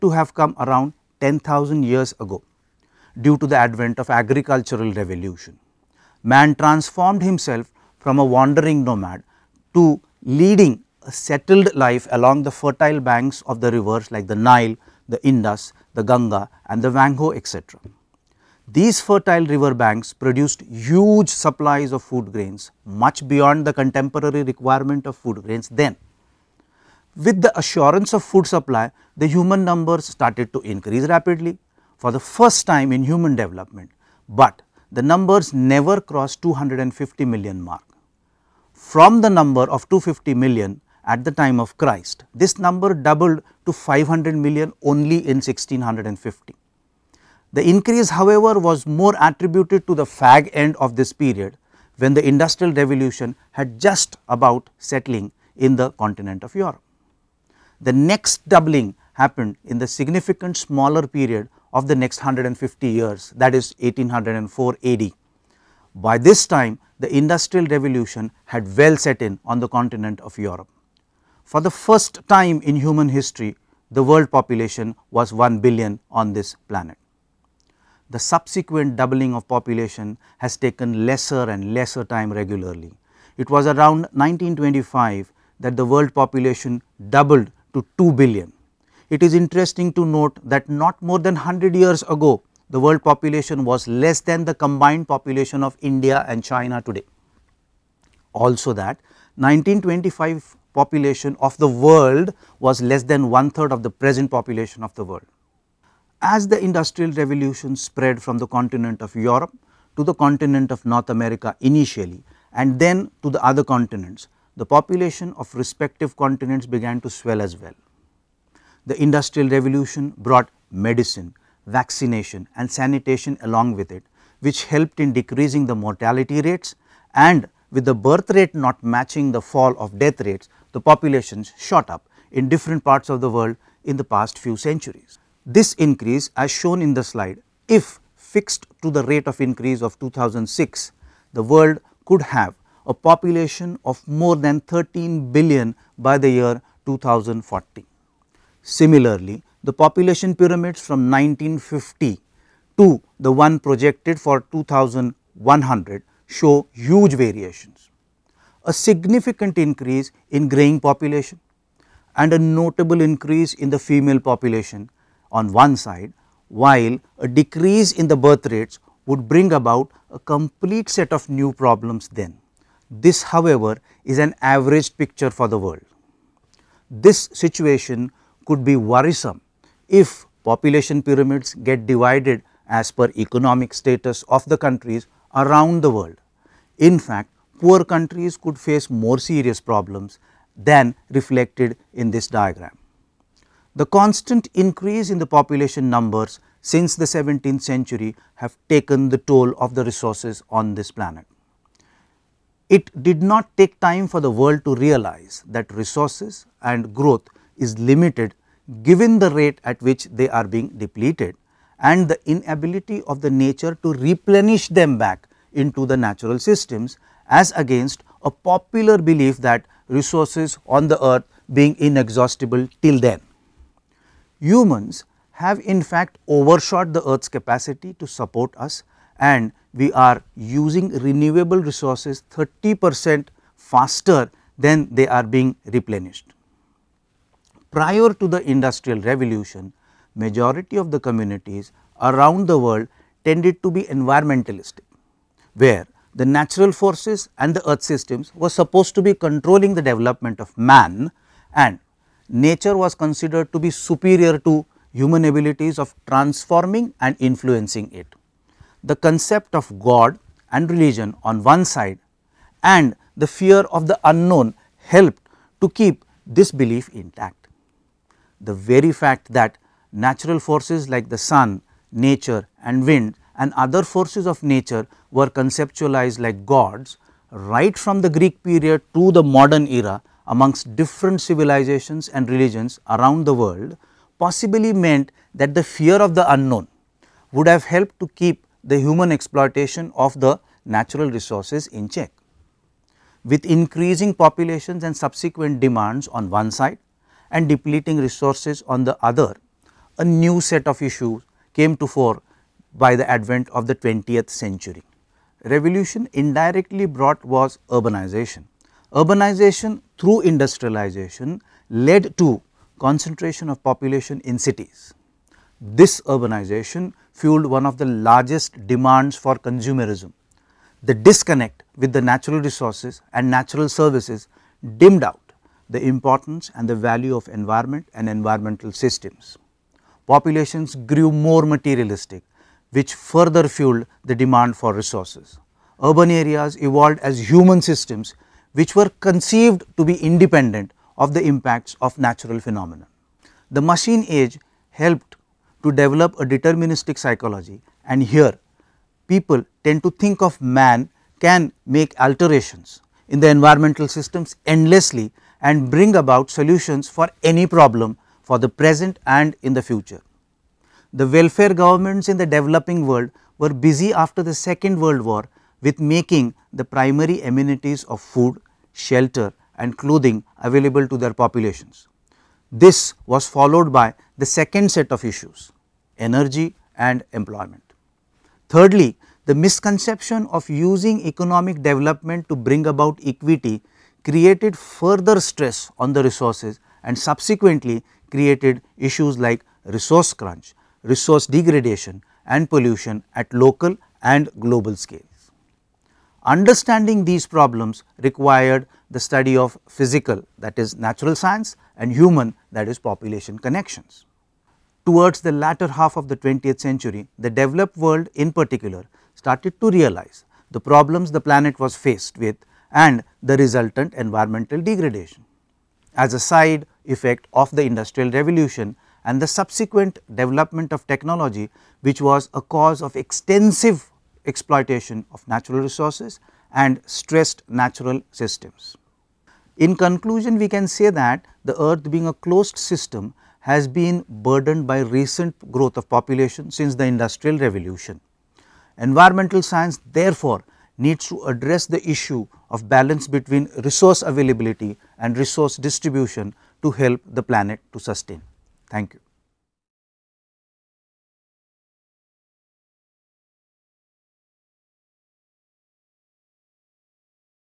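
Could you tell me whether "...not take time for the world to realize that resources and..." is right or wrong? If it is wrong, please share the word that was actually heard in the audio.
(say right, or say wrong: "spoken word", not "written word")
right.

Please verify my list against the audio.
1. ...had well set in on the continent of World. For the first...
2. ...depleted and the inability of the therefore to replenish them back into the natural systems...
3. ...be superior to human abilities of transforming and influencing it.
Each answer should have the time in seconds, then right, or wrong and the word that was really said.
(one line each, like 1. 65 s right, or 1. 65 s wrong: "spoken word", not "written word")
1. 68 s wrong: "Europe", not "World"
2. 210 s wrong: "nature", not "therefore"
3. 253 s right.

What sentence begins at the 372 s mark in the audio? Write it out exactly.
This was followed by the second set of issues, energy and employment.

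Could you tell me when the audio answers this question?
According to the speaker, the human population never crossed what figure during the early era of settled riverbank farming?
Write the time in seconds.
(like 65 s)
36 s.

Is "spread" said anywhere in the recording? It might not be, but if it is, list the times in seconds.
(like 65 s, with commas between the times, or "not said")
107 s.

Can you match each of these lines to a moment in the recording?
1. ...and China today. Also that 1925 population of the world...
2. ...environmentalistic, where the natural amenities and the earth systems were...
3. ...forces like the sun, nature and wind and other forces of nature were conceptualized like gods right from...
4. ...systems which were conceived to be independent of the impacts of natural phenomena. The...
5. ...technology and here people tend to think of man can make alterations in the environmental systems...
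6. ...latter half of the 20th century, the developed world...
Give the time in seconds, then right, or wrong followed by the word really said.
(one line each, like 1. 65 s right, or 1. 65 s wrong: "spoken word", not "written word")
1. 96 s right
2. 243 s wrong: "forces", not "amenities"
3. 270 s right
4. 337 s right
5. 346 s wrong: "psychology", not "technology"
6. 405 s right.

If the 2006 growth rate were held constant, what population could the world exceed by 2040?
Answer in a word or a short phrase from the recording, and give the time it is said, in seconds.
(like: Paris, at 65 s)
13 billion, at 144 s.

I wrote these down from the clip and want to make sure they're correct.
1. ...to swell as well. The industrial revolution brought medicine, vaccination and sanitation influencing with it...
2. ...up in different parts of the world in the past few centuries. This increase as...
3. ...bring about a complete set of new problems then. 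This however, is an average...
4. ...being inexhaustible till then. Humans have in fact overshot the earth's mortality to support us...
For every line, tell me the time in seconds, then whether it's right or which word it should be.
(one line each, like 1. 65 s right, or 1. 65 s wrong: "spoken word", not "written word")
1. 117 s wrong: "along", not "influencing"
2. 131 s right
3. 169 s right
4. 221 s wrong: "capacity", not "mortality".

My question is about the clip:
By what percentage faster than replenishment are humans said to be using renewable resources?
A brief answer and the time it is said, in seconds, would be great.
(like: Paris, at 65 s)
30 percent, at 232 s.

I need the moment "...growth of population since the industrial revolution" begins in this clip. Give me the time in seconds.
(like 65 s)
435 s.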